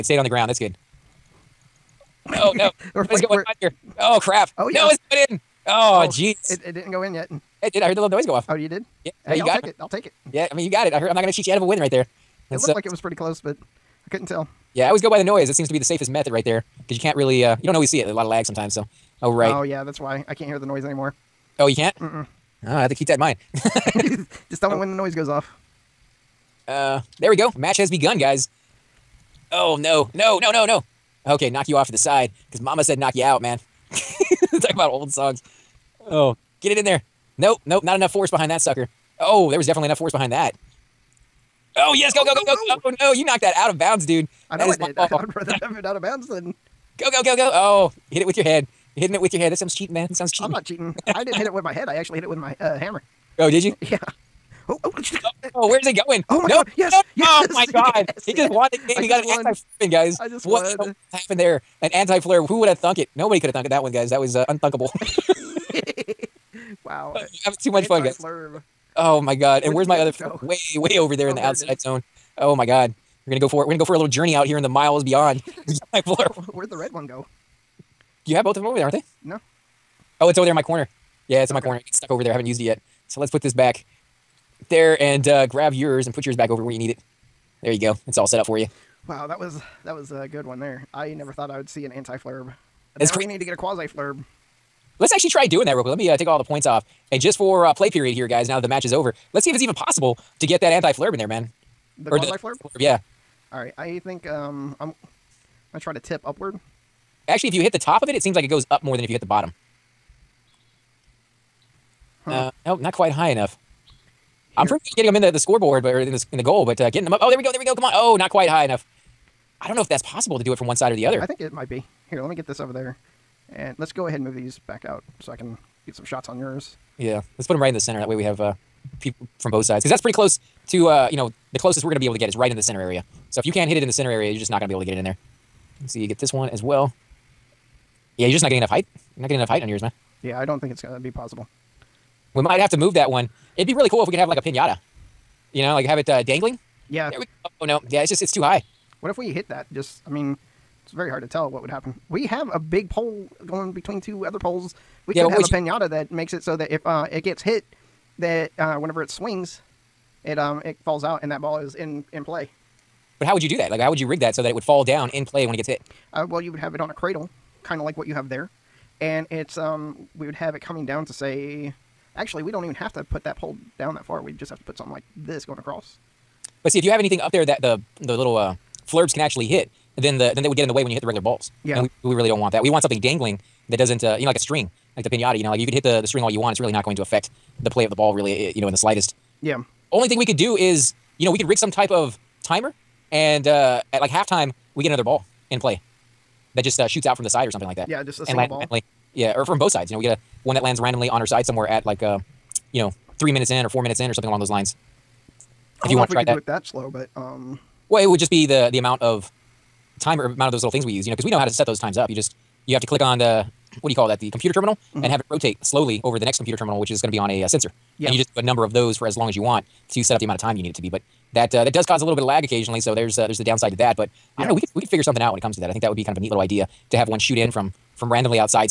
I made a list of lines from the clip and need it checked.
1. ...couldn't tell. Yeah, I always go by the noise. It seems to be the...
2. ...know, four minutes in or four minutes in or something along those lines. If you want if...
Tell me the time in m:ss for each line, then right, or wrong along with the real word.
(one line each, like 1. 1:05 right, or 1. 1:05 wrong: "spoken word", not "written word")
1. 0:14 right
2. 3:22 wrong: "three", not "four".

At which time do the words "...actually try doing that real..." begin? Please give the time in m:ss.
1:35.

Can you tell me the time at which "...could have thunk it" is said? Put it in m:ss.
1:03.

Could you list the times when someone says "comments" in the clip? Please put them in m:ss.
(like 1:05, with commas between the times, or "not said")
not said.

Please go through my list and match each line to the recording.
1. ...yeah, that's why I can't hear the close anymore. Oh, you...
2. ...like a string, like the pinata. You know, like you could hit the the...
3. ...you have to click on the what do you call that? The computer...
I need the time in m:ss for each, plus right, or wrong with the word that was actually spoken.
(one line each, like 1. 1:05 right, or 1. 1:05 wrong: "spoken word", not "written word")
1. 0:19 wrong: "noise", not "close"
2. 3:04 right
3. 3:32 right.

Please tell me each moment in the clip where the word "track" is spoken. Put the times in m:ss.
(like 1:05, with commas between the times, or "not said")
not said.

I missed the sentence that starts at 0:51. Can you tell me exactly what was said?
I didn't hit it with my head.